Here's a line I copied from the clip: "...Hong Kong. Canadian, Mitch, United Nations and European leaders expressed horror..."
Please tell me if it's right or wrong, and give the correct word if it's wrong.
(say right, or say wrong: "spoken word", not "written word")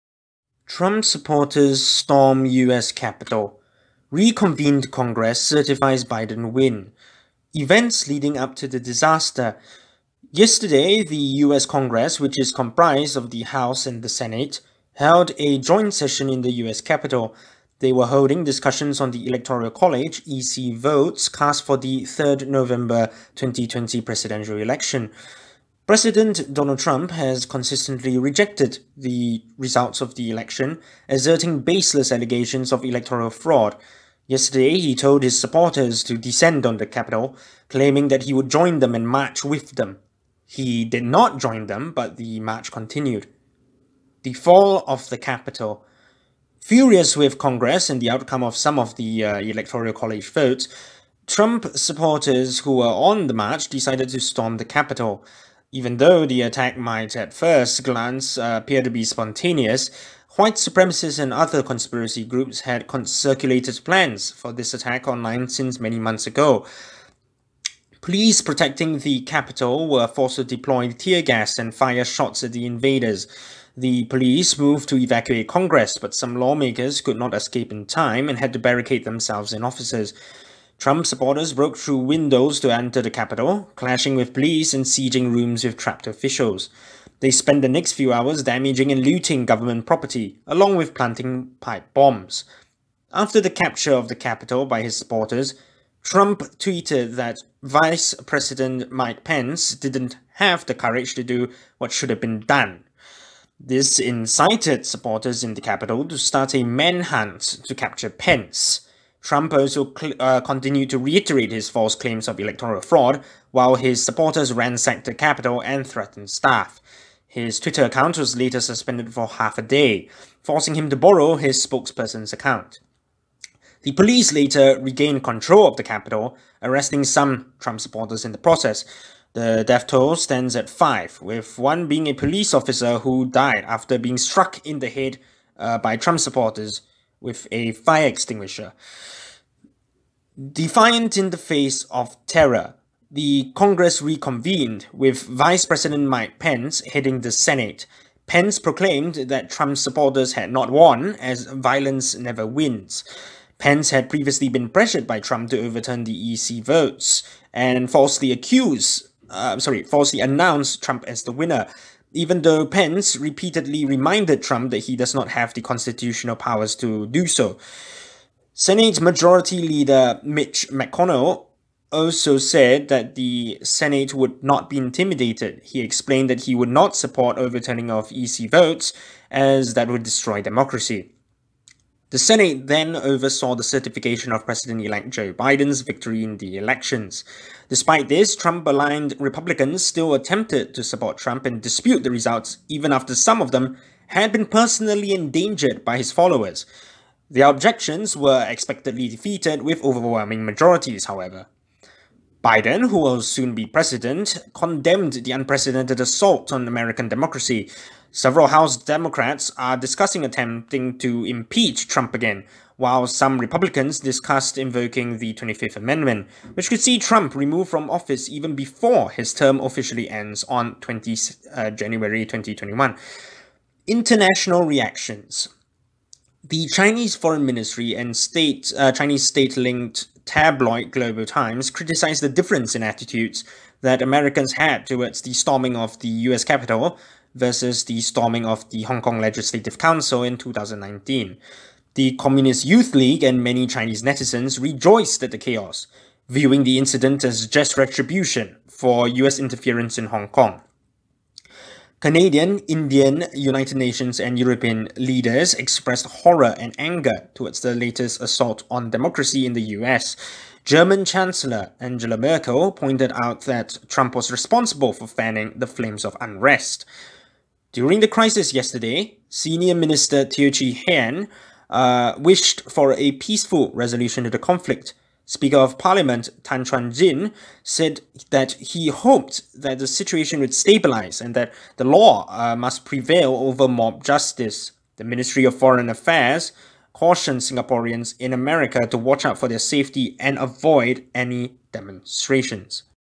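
wrong: "Indian", not "Mitch".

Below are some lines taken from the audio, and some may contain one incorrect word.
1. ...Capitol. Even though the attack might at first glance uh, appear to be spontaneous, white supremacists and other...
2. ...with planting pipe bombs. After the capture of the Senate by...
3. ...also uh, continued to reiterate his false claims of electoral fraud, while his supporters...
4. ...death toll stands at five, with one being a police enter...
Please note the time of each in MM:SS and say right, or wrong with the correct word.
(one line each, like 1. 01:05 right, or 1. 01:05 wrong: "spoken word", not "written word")
1. 00:54 right
2. 01:30 wrong: "Capitol", not "Senate"
3. 01:49 right
4. 02:09 wrong: "officer", not "enter".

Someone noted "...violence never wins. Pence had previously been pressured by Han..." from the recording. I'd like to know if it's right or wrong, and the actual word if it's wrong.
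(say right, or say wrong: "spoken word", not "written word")
wrong: "Trump", not "Han".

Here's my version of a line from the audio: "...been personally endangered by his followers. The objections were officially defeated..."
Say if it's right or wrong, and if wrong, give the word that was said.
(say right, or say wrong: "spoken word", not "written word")
wrong: "expectedly", not "officially".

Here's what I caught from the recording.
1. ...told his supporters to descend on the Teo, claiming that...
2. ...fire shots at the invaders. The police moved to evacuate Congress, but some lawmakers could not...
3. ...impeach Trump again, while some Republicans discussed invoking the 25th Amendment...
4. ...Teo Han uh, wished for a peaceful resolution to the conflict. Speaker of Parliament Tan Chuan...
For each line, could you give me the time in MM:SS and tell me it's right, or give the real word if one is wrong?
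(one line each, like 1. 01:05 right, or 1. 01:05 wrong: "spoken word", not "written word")
1. 00:34 wrong: "Capitol", not "Teo"
2. 01:11 right
3. 03:31 right
4. 04:30 right.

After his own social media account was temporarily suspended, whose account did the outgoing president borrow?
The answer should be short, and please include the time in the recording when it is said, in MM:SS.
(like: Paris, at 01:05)
his spokesperson's, at 02:01.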